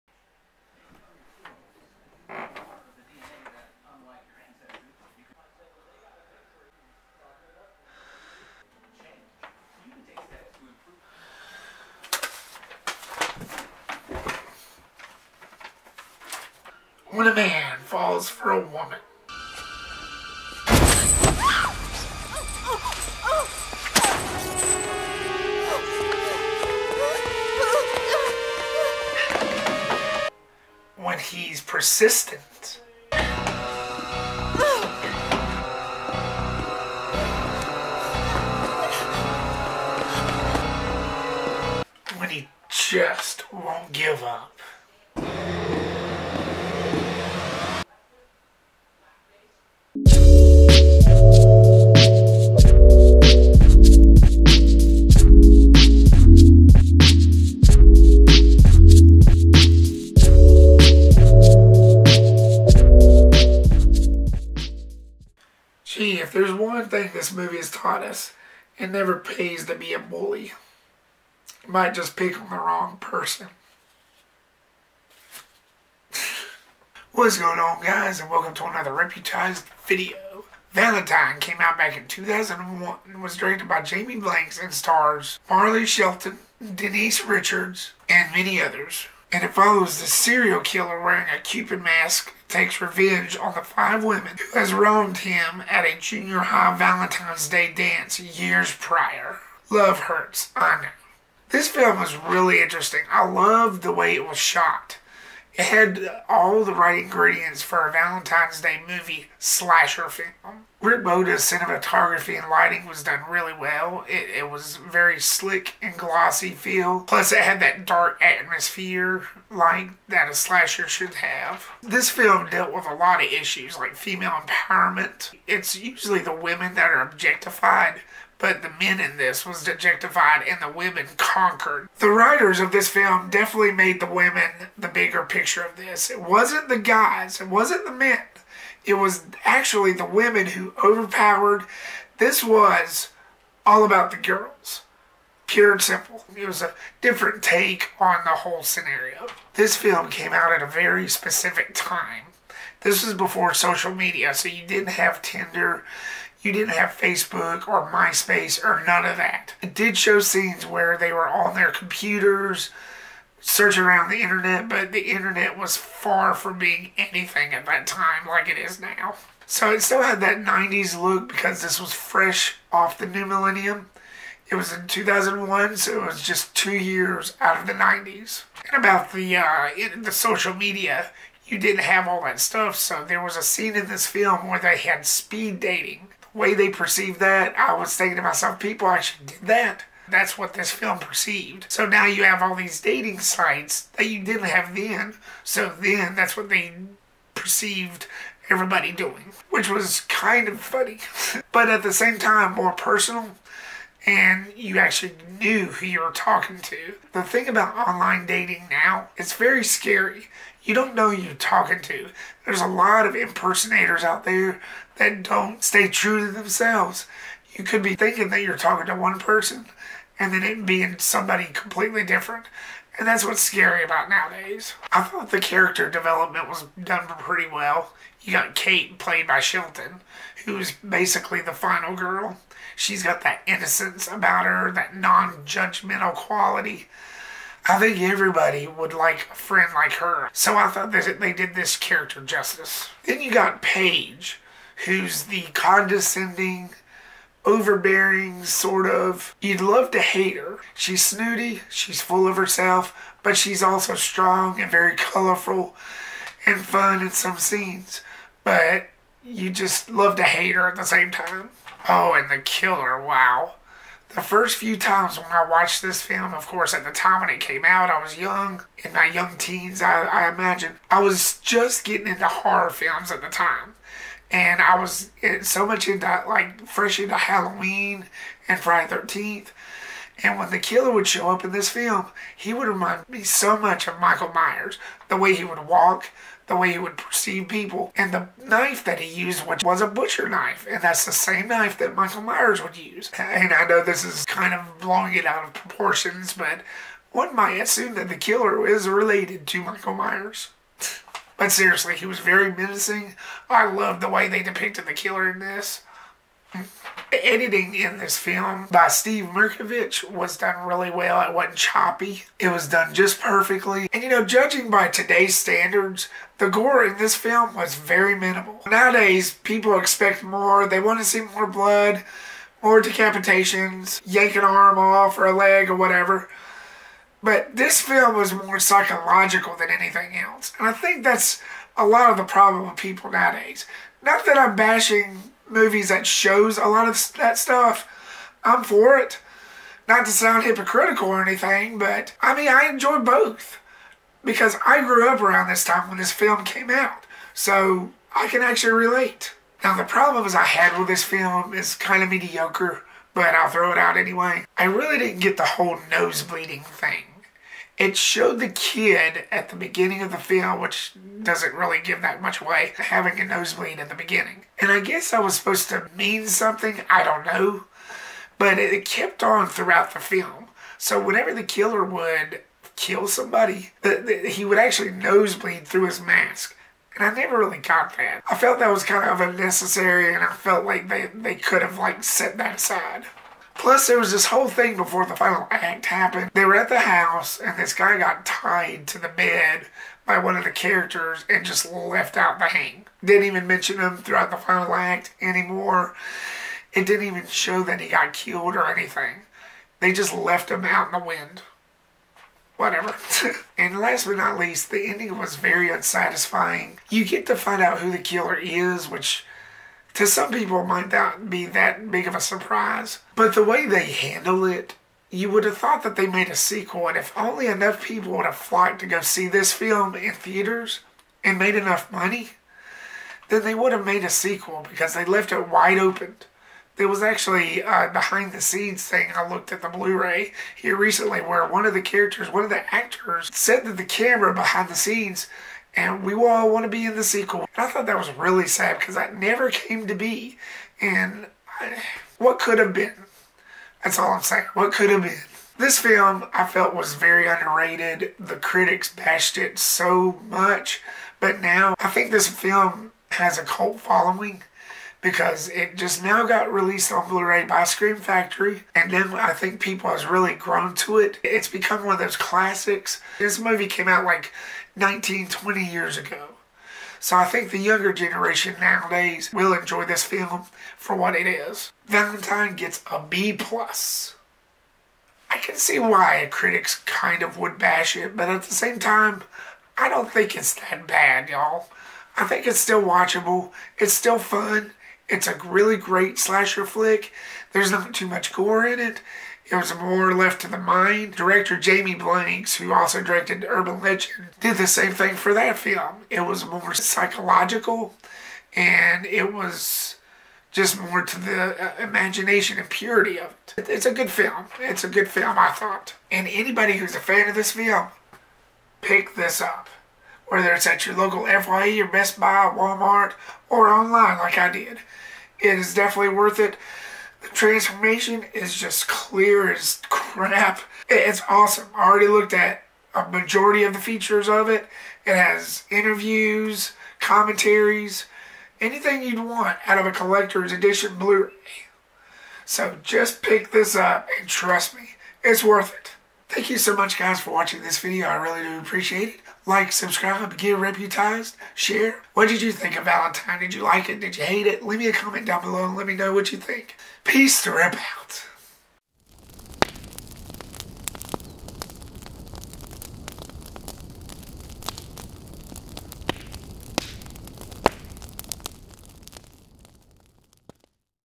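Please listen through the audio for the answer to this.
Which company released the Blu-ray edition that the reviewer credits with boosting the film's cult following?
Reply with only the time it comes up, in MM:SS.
07:37.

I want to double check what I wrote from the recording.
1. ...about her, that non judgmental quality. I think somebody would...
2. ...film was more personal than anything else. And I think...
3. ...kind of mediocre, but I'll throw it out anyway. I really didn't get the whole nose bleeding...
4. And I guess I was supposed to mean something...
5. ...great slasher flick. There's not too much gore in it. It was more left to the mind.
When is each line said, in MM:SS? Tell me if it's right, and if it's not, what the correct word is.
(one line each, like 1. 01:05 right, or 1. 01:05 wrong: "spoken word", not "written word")
1. 03:54 wrong: "everybody", not "somebody"
2. 05:27 wrong: "psychological", not "personal"
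3. 05:51 right
4. 06:04 right
5. 08:05 right.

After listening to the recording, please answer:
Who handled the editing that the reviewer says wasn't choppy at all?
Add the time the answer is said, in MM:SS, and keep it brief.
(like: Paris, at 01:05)
Steve Mirkovich, at 05:08.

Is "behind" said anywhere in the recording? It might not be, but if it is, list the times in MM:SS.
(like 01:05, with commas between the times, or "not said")
07:07, 07:14.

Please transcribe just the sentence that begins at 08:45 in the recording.
It has interviews, commentaries, anything you'd want out of a collector's edition Blu ray.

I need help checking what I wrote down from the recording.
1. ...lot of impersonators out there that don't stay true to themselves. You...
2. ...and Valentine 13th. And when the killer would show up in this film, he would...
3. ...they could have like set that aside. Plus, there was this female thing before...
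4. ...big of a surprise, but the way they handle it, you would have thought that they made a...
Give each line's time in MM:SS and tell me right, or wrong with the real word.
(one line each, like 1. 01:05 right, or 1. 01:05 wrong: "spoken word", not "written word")
1. 03:32 right
2. 04:38 wrong: "Friday", not "Valentine"
3. 06:21 wrong: "whole", not "female"
4. 06:51 right.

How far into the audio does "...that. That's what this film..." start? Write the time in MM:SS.
03:09.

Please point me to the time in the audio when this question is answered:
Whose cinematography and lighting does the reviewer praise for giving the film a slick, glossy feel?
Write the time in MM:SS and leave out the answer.
01:50.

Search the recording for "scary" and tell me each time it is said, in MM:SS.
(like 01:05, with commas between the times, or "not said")
03:29, 03:43.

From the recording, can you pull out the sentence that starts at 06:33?
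Didn't even mention him throughout the final act anymore.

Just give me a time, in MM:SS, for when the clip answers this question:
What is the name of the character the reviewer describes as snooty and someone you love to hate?
04:03.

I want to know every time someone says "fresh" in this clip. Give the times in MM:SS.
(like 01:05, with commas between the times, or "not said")
02:51, 04:36.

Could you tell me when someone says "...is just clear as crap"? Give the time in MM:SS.
08:38.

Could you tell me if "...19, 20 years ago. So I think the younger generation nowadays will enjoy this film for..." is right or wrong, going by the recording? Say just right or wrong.
right.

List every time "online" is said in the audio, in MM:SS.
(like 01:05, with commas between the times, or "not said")
03:27, 08:33.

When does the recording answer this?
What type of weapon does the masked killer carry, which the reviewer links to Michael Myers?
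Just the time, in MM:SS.
04:49.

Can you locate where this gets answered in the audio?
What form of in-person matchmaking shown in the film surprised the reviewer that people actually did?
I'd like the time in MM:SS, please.
03:05.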